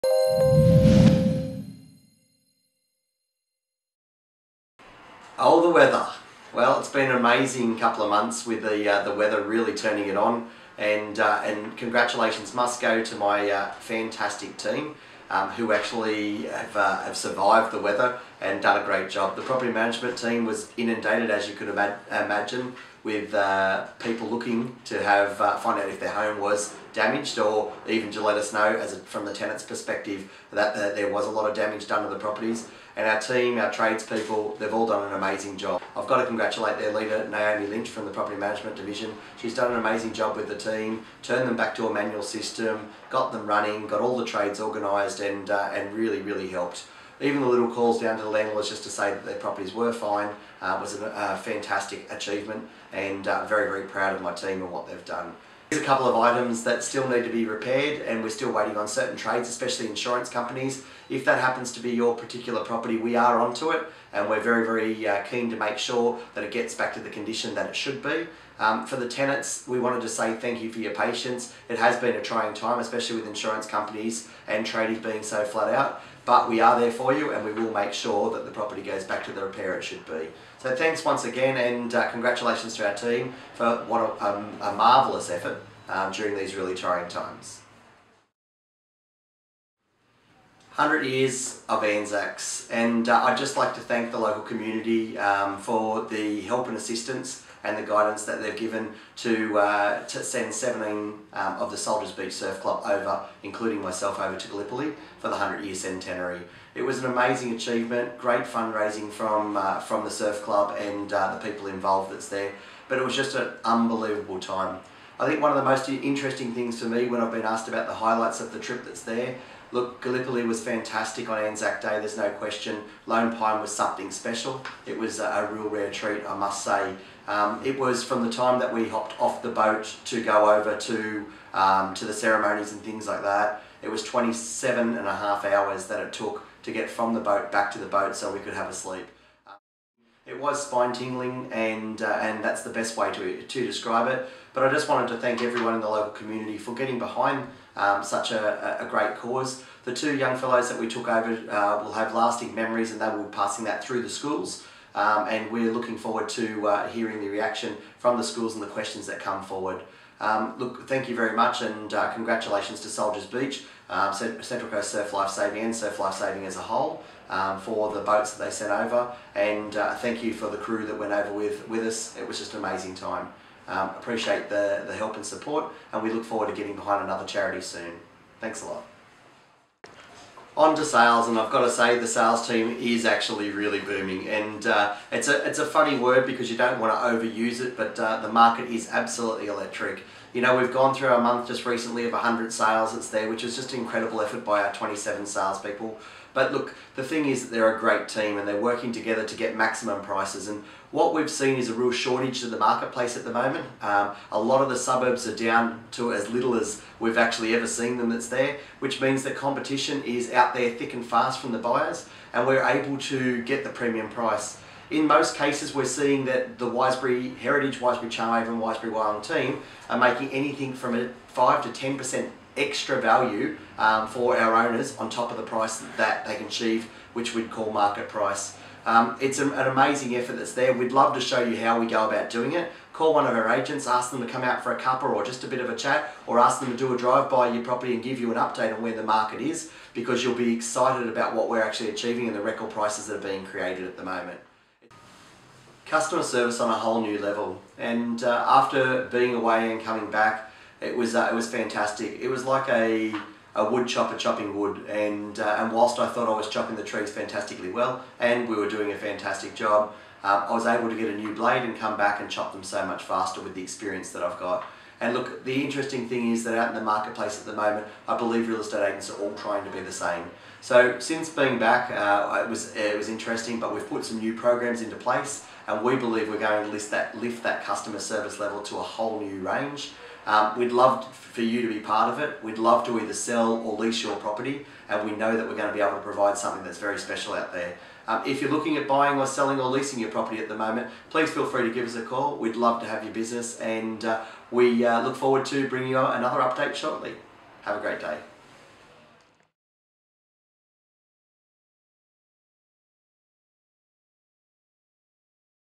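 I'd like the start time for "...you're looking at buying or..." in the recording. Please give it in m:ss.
4:48.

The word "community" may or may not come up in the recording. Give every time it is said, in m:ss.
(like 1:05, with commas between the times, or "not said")
1:34, 2:26.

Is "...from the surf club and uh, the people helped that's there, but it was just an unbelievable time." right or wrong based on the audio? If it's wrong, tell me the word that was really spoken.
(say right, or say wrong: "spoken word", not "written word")
wrong: "involved", not "helped".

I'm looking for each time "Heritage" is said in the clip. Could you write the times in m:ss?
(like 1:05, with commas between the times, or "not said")
3:37.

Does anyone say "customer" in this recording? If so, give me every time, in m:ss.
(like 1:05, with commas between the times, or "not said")
4:05, 4:37.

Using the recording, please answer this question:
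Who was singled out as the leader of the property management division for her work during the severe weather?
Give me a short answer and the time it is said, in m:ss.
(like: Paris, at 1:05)
Naomi Lynch, at 0:37.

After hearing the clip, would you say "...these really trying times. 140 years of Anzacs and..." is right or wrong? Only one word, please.
wrong.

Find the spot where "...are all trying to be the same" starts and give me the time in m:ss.
4:29.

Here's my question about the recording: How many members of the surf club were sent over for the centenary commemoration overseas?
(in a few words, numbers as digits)
17.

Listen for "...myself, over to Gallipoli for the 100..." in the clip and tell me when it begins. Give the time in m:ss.
1:43.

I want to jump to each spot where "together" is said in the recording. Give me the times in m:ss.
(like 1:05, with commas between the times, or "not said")
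3:18.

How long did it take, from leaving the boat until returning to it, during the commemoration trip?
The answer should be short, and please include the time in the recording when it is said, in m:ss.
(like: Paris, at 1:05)
27 and a half hours, at 2:14.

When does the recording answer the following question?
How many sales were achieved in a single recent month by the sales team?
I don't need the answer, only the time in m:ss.
3:12.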